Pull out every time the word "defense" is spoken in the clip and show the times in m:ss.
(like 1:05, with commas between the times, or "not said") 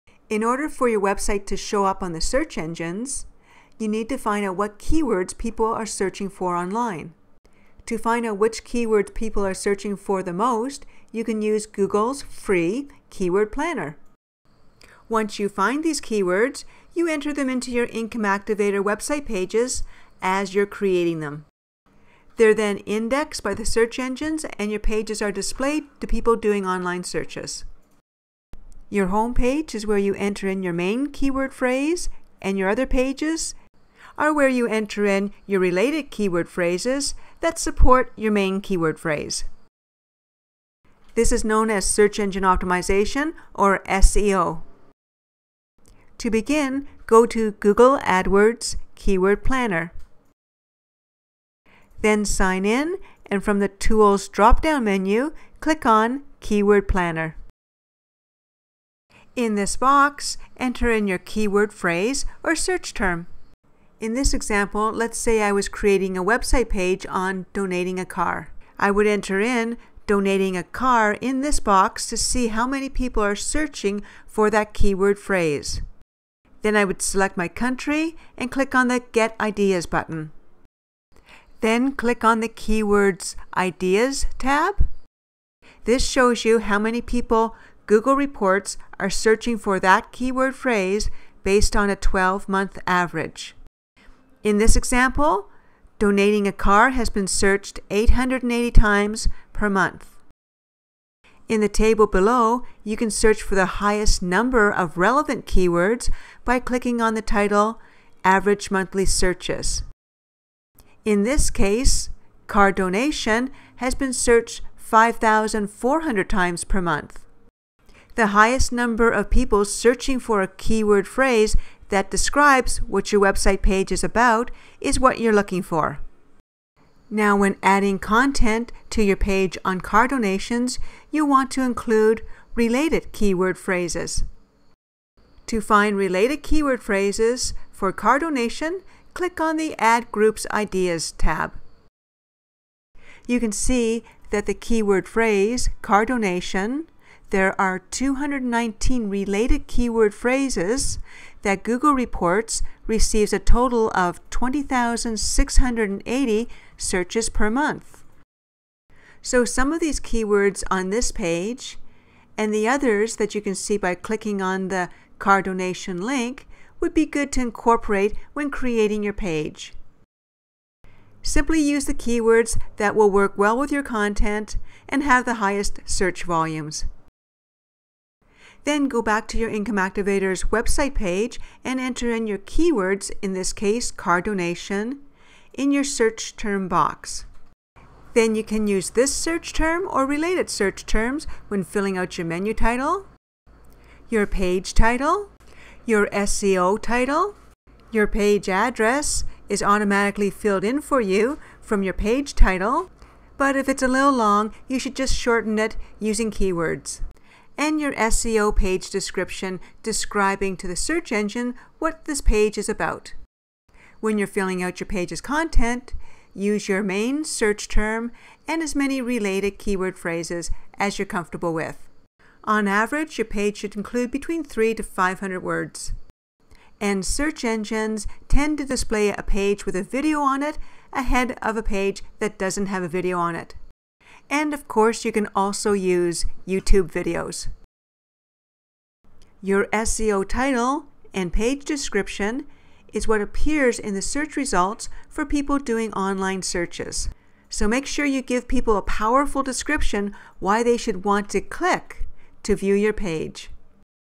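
not said.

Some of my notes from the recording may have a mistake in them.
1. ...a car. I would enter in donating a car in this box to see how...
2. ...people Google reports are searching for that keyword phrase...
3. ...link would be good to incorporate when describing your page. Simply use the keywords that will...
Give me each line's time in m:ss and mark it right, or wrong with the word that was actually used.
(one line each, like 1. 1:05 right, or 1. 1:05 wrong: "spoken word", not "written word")
1. 1:07 right
2. 1:27 right
3. 2:46 wrong: "creating", not "describing".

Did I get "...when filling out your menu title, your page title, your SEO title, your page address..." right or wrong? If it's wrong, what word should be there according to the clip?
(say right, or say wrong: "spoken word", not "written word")
right.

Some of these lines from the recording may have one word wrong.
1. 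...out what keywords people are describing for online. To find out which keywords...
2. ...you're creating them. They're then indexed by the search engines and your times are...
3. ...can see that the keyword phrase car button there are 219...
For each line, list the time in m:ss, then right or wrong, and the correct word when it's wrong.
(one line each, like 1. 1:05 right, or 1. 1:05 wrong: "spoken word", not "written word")
1. 0:04 wrong: "searching", not "describing"
2. 0:20 wrong: "pages", not "times"
3. 2:23 wrong: "donation", not "button".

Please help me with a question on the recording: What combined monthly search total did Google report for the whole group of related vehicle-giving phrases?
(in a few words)
20,680.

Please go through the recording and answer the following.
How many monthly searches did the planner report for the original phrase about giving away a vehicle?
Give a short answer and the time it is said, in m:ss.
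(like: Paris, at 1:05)
880, at 1:37.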